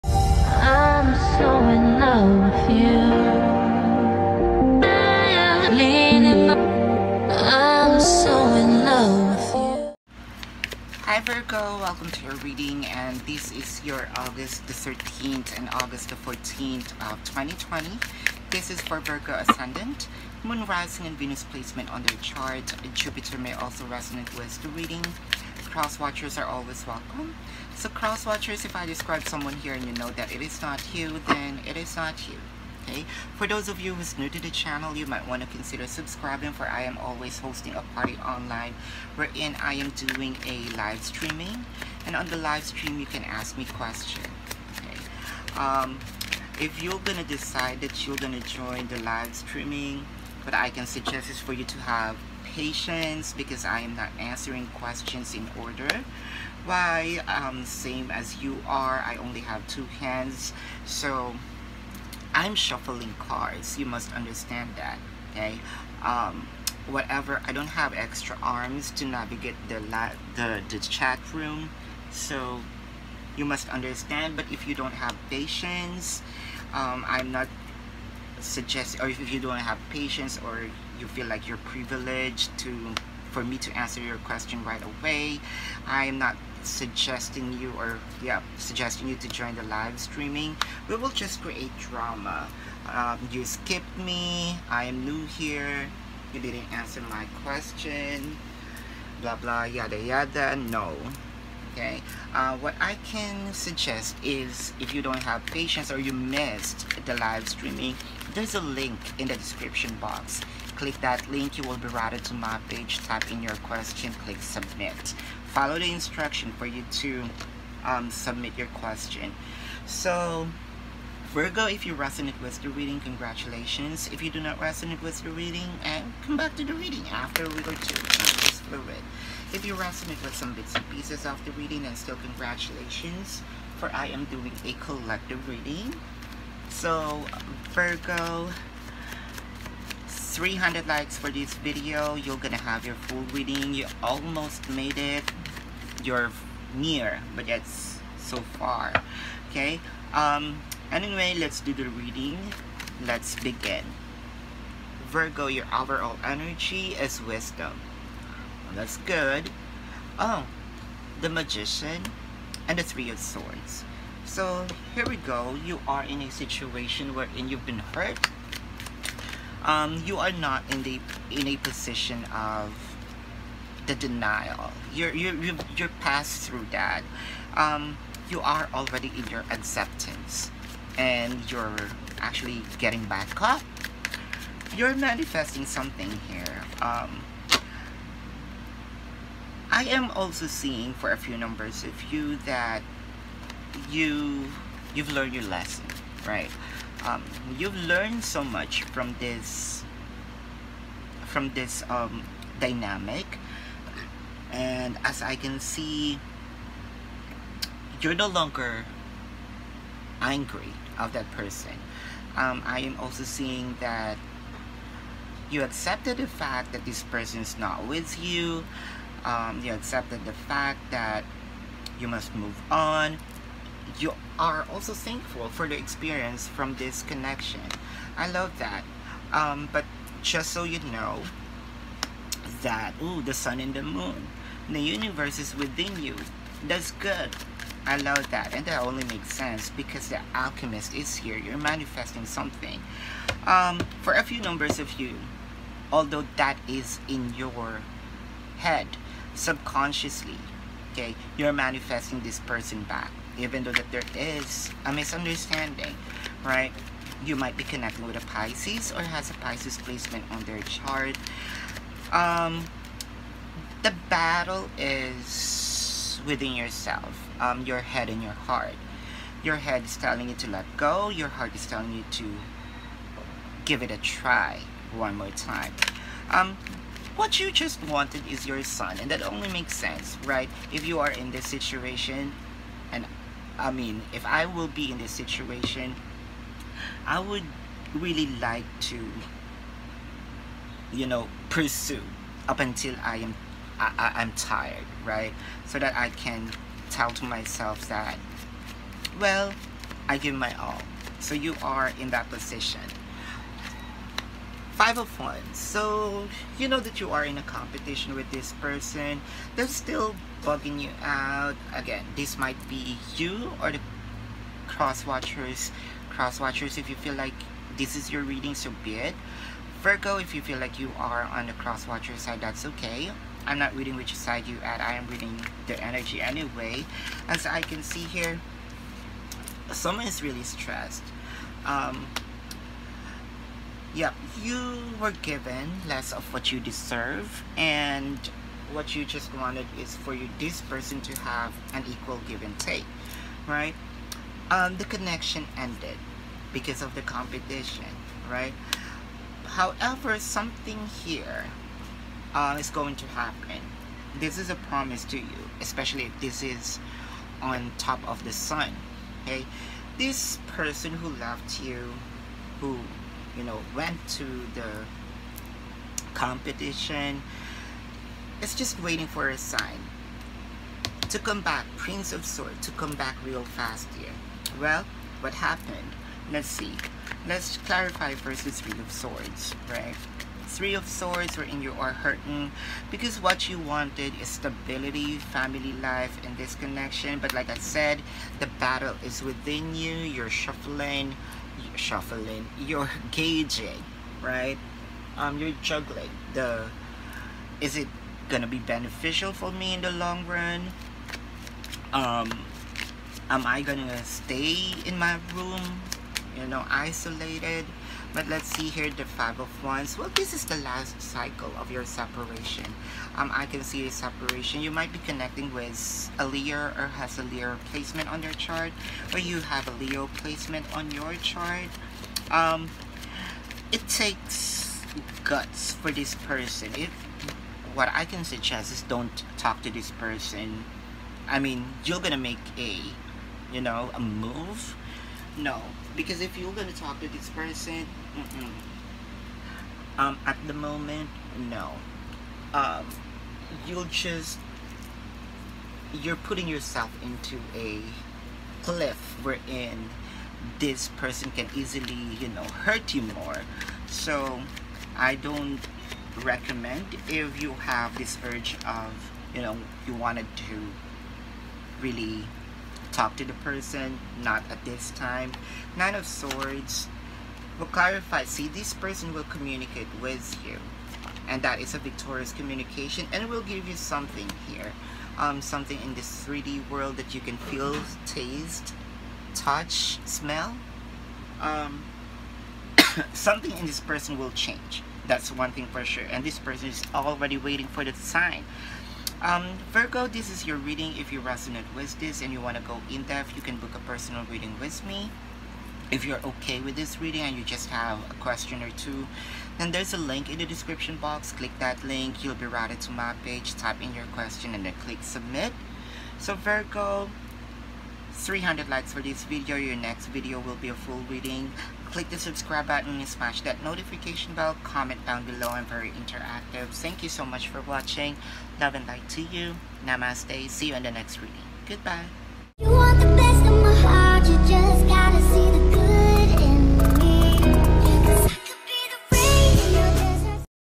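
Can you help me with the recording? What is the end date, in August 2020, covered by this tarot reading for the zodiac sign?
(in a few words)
August 14.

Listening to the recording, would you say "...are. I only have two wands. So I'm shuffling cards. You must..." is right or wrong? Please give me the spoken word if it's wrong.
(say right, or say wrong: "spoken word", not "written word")
wrong: "hands", not "wands".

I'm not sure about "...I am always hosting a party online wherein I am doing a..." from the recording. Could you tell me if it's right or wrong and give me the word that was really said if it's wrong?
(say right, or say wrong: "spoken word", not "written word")
right.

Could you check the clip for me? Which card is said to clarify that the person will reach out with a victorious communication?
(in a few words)
Nine of Swords.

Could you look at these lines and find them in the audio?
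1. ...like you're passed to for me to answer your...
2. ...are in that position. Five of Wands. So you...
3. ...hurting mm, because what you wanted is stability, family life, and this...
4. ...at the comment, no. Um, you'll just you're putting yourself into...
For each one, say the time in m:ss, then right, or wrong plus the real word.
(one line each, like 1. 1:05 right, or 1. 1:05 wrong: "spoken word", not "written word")
1. 1:21 wrong: "privileged", not "passed"
2. 5:01 right
3. 6:21 right
4. 7:20 wrong: "moment", not "comment".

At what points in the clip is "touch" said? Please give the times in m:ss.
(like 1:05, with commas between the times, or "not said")
7:59.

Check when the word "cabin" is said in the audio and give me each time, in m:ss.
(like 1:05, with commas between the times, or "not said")
not said.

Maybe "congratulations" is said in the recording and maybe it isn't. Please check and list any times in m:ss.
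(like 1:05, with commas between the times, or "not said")
2:02, 2:12.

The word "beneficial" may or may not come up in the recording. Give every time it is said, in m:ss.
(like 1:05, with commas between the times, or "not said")
6:38.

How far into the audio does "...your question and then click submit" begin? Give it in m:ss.
8:23.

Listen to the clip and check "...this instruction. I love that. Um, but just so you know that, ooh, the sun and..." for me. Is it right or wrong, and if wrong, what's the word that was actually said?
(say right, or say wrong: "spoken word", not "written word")
wrong: "connection", not "instruction".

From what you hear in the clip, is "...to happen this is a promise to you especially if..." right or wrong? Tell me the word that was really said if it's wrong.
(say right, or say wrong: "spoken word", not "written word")
right.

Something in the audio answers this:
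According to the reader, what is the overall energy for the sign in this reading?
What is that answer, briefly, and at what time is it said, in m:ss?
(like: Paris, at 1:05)
wisdom, at 2:37.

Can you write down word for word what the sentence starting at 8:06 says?
And this person is already waiting for the sign.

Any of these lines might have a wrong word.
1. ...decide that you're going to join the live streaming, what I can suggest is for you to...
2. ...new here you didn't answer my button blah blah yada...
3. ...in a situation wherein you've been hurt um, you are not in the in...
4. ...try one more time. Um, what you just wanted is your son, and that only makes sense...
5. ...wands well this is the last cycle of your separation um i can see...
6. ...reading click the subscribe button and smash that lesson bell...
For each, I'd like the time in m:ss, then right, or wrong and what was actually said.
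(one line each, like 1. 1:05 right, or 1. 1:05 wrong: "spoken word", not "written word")
1. 0:47 right
2. 1:35 wrong: "question", not "button"
3. 2:46 right
4. 4:33 right
5. 6:49 right
6. 8:31 wrong: "notification", not "lesson".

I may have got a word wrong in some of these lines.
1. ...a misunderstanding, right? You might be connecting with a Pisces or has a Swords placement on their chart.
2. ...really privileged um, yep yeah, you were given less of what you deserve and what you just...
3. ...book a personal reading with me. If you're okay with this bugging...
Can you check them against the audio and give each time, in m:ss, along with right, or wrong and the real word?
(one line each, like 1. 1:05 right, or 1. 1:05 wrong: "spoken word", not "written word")
1. 4:14 wrong: "Pisces", not "Swords"
2. 5:30 wrong: "stressed", not "privileged"
3. 8:13 wrong: "reading", not "bugging".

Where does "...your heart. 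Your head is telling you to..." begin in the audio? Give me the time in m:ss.
4:28.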